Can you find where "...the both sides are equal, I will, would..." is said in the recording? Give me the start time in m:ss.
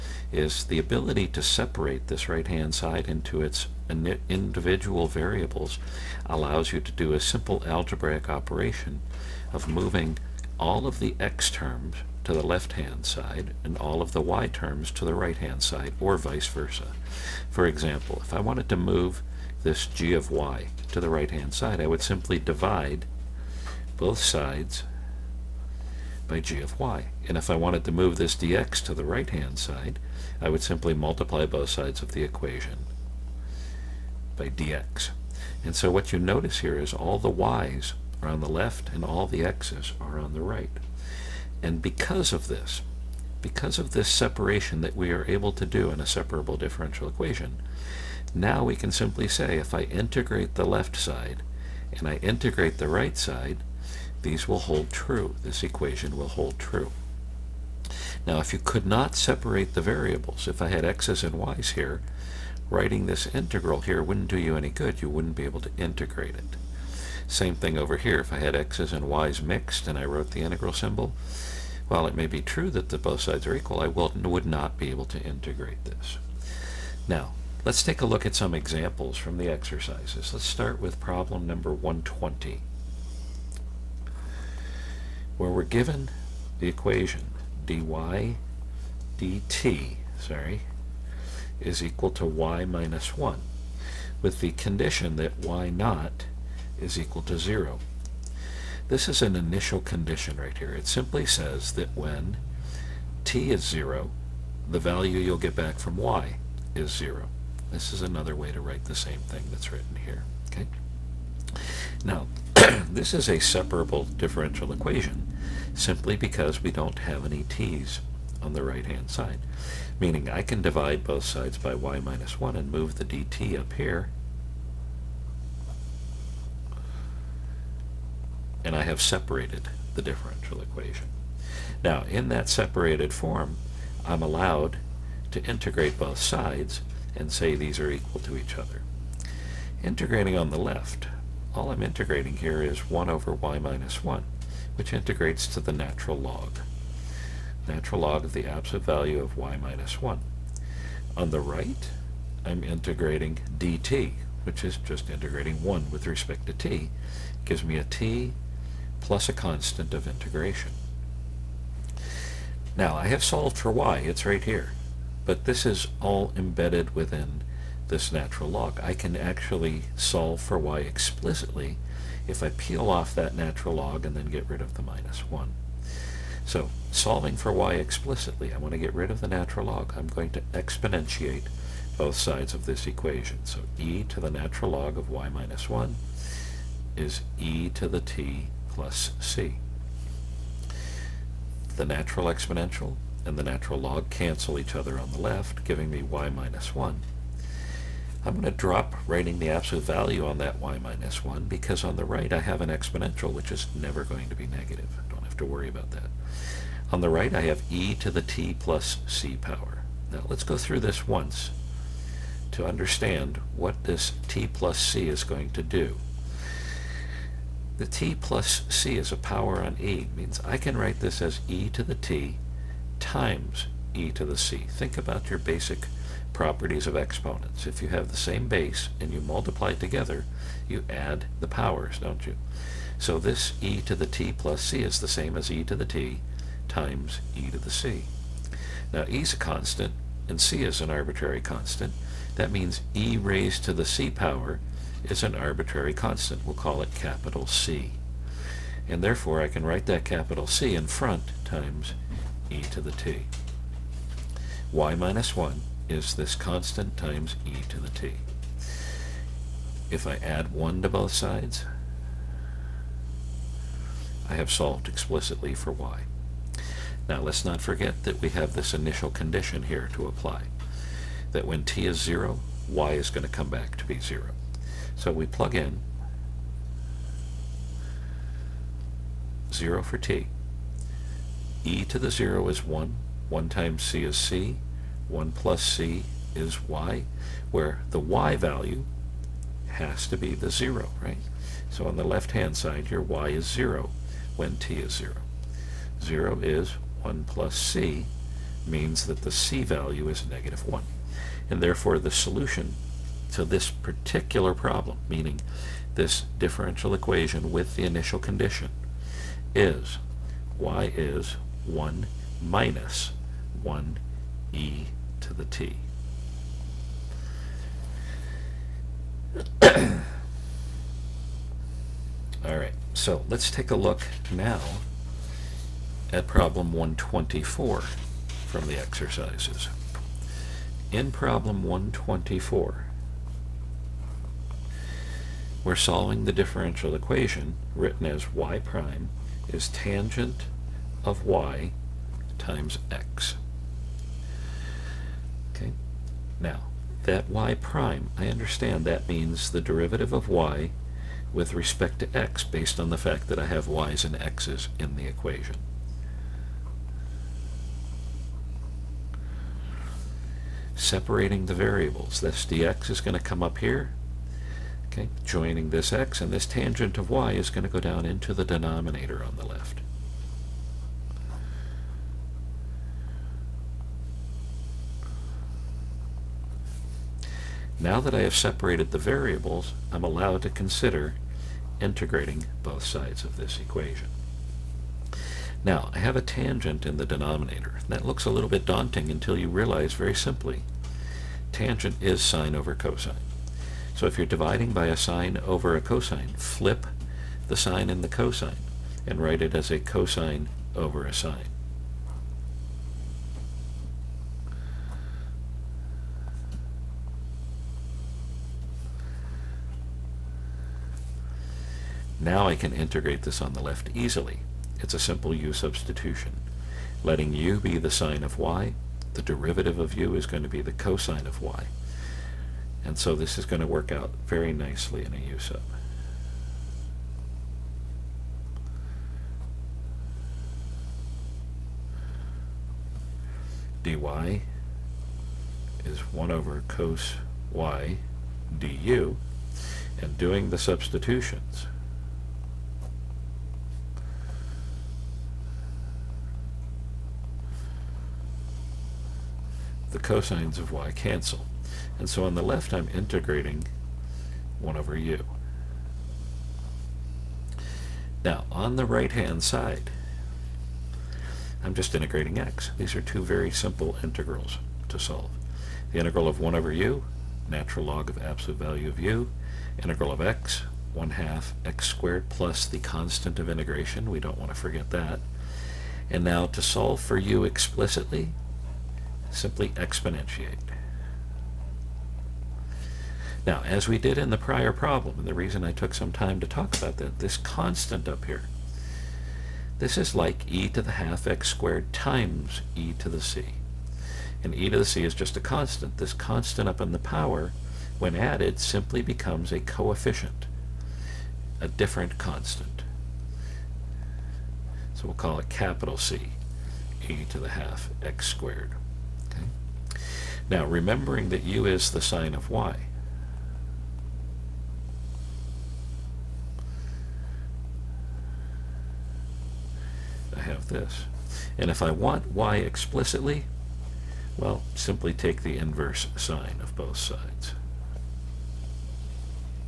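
1:12.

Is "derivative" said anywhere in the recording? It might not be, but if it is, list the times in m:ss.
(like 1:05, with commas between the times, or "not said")
5:49, 6:59.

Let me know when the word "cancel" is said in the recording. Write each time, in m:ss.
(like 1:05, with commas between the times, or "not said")
3:14, 7:30.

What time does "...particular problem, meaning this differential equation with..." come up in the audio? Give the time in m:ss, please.
5:03.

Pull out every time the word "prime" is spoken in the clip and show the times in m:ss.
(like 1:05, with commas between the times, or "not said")
5:38, 5:47.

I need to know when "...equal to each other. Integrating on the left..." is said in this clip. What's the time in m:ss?
2:17.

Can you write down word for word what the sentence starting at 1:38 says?
This is an initial condition right here.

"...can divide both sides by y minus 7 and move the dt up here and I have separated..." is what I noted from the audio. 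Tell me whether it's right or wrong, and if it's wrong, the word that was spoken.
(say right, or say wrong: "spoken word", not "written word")
wrong: "1", not "7".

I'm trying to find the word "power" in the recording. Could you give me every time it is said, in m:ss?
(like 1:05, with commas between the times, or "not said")
3:29, 3:39, 3:51, 4:04, 8:16.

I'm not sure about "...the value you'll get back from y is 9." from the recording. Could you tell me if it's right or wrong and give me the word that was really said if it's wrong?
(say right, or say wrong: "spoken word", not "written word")
wrong: "0", not "9".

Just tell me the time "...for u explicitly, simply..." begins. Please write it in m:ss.
7:56.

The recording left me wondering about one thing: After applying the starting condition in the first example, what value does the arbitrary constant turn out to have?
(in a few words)
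-1.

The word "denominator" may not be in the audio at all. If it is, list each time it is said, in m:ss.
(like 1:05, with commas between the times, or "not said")
6:08, 6:27.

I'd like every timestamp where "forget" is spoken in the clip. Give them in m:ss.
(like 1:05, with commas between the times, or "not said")
4:27, 7:54.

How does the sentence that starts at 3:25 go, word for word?
I don't have to worry about that.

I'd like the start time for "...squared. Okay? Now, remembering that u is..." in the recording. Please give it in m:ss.
8:28.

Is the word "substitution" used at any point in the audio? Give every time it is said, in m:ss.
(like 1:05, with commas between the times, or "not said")
6:55, 7:20.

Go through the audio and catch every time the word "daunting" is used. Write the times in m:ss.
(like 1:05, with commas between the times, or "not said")
6:28.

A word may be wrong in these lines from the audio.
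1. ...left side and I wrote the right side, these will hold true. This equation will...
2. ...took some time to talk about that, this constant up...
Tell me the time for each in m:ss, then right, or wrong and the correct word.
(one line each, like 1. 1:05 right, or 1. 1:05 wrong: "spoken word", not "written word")
1. 0:50 wrong: "integrate", not "wrote"
2. 8:05 right.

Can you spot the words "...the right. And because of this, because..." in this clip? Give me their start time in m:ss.
0:40.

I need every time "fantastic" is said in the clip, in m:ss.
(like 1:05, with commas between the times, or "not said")
not said.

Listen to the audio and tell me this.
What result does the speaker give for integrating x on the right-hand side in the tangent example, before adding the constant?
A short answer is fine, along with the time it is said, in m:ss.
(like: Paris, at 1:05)
1/2 x squared, at 7:50.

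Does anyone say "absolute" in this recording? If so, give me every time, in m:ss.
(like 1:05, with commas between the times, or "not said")
2:28, 3:19, 7:48.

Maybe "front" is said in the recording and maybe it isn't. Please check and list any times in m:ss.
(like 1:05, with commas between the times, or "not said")
4:10.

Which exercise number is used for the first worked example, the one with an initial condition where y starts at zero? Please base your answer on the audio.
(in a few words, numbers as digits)
120.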